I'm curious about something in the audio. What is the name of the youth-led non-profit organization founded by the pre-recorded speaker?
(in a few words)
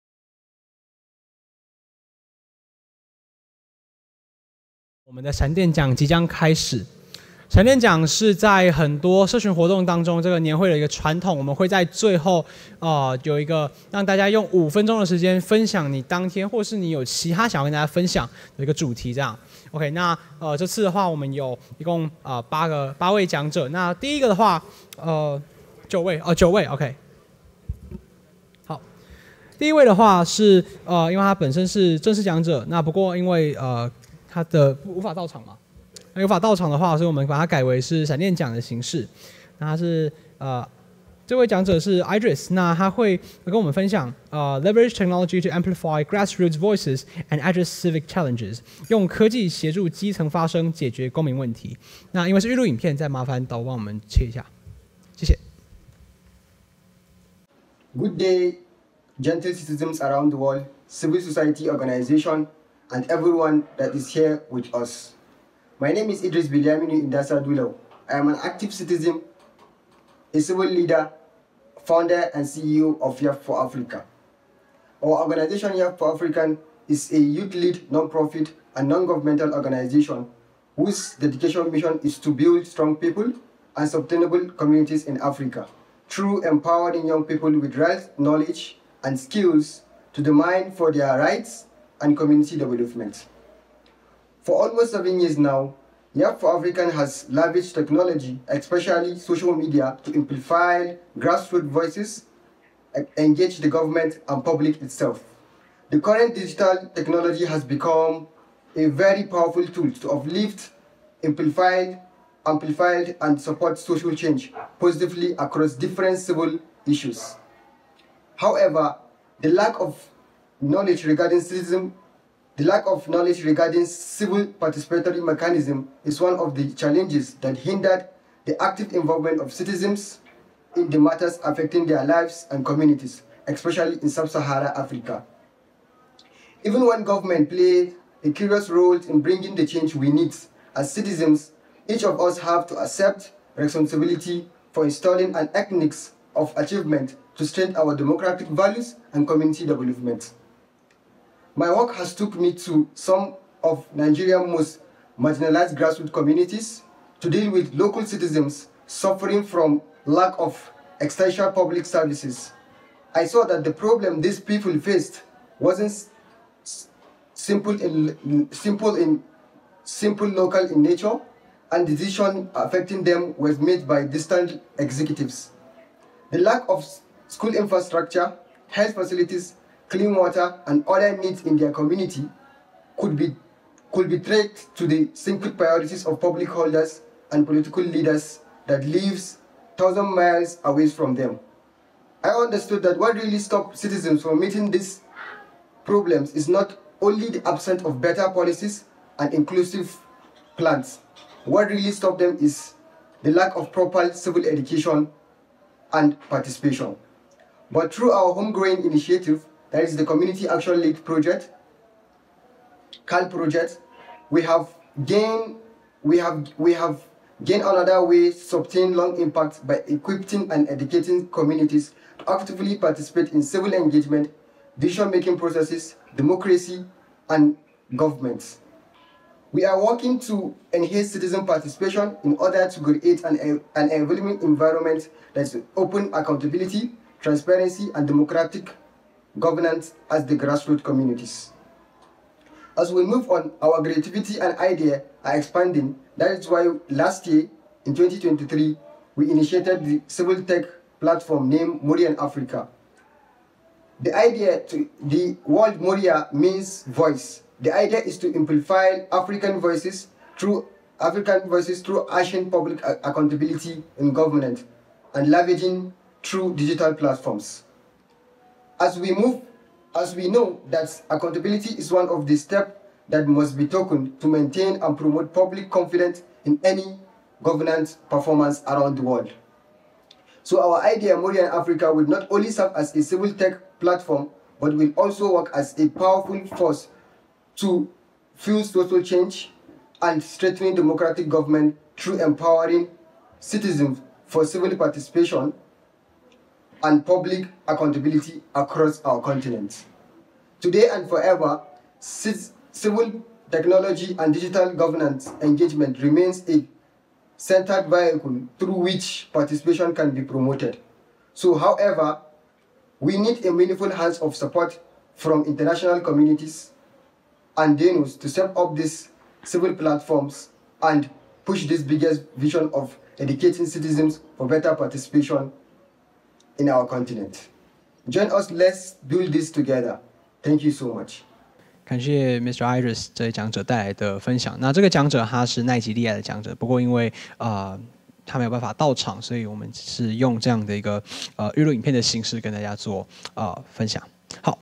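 Yap for Africa.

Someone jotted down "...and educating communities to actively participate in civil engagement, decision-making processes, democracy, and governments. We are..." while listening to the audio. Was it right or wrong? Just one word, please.
right.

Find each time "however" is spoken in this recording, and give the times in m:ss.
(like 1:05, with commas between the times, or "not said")
1:58, 5:11.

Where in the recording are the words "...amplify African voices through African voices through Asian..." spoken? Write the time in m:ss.
4:18.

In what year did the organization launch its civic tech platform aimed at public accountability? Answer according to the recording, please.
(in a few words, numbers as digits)
2023.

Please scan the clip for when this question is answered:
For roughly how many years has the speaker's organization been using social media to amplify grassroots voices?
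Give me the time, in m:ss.
1:34.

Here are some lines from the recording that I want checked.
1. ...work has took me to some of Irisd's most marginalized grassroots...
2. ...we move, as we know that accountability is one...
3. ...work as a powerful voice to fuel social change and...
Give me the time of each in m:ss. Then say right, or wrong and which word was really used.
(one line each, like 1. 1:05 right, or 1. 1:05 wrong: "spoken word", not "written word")
1. 2:31 wrong: "Nigeria", not "Irisd"
2. 4:28 right
3. 4:45 wrong: "force", not "voice".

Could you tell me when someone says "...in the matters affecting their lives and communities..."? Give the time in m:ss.
2:10.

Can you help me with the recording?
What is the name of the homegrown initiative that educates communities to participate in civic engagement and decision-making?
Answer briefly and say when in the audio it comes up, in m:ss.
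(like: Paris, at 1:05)
Community Action League project, at 3:30.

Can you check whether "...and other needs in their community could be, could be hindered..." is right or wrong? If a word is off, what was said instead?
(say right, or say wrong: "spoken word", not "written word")
wrong: "traced", not "hindered".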